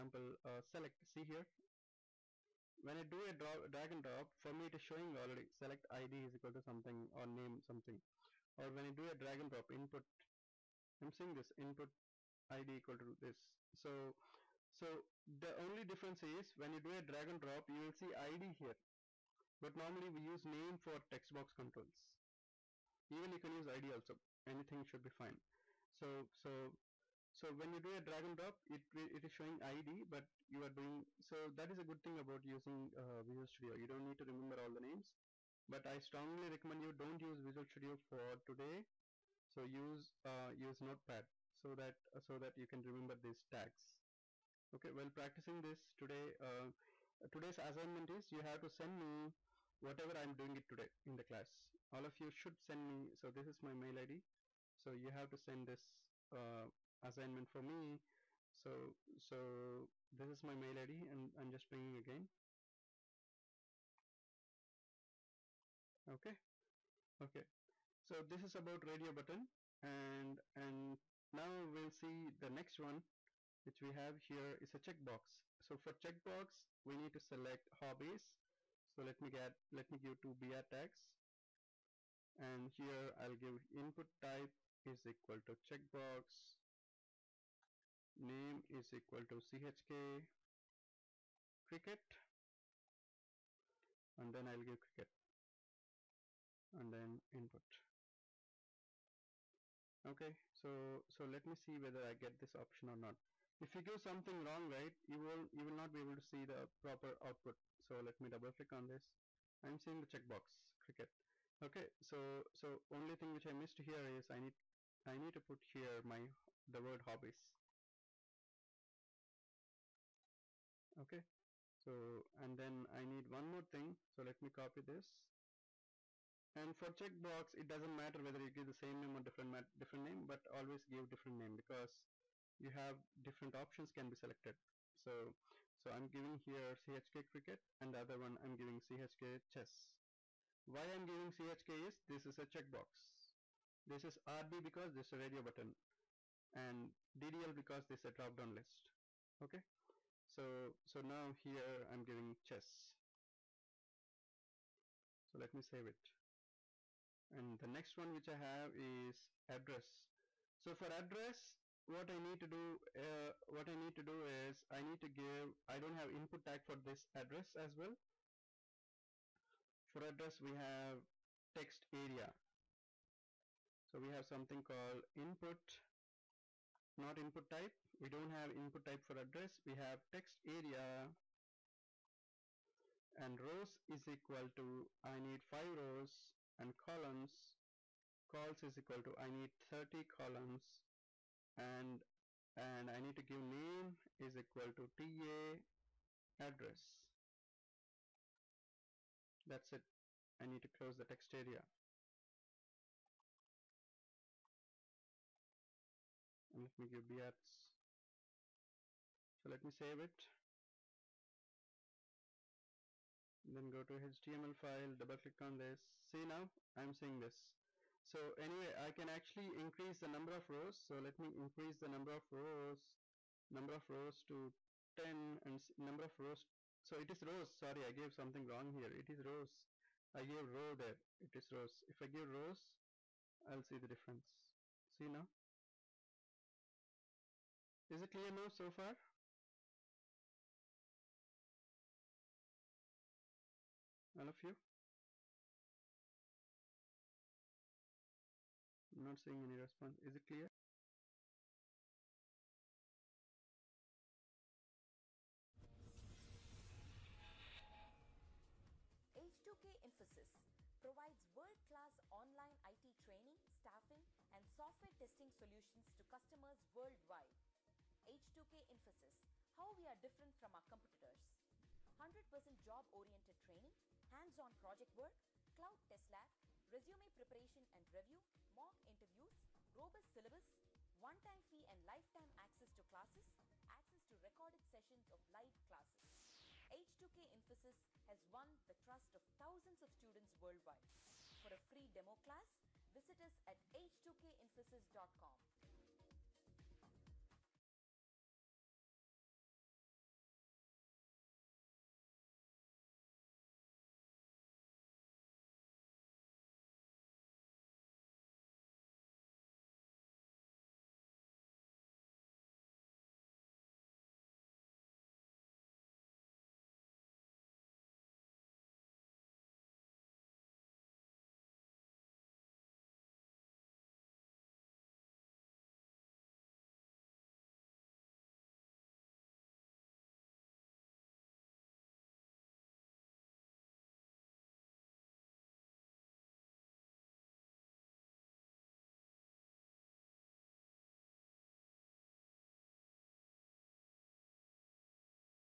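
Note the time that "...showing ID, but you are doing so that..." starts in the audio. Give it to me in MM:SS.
00:29.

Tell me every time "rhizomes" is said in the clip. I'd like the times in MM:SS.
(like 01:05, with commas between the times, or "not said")
not said.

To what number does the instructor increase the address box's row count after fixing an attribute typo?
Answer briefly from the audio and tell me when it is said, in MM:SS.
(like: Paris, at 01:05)
10, at 03:45.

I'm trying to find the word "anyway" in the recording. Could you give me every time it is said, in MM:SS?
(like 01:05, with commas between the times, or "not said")
03:38.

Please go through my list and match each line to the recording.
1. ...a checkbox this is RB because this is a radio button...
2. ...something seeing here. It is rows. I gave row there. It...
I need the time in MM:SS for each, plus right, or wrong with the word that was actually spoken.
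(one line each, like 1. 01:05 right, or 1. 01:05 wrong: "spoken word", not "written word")
1. 02:22 right
2. 03:48 wrong: "wrong", not "seeing".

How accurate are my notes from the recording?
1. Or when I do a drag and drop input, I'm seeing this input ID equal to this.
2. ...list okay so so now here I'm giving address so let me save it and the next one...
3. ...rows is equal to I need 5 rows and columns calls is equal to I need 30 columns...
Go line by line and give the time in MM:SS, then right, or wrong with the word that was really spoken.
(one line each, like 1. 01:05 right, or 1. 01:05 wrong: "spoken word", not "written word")
1. 00:08 right
2. 02:28 wrong: "chess", not "address"
3. 03:03 right.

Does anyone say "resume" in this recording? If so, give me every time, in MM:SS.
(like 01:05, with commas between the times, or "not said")
04:36.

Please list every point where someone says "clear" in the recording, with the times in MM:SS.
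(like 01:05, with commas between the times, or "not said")
03:58, 04:10.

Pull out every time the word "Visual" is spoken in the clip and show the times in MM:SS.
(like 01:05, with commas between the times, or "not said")
00:33, 00:37.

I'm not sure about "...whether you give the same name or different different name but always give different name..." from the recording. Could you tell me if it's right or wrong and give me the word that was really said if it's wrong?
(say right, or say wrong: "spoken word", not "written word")
right.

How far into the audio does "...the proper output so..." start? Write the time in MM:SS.
01:46.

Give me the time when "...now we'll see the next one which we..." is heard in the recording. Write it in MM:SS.
01:11.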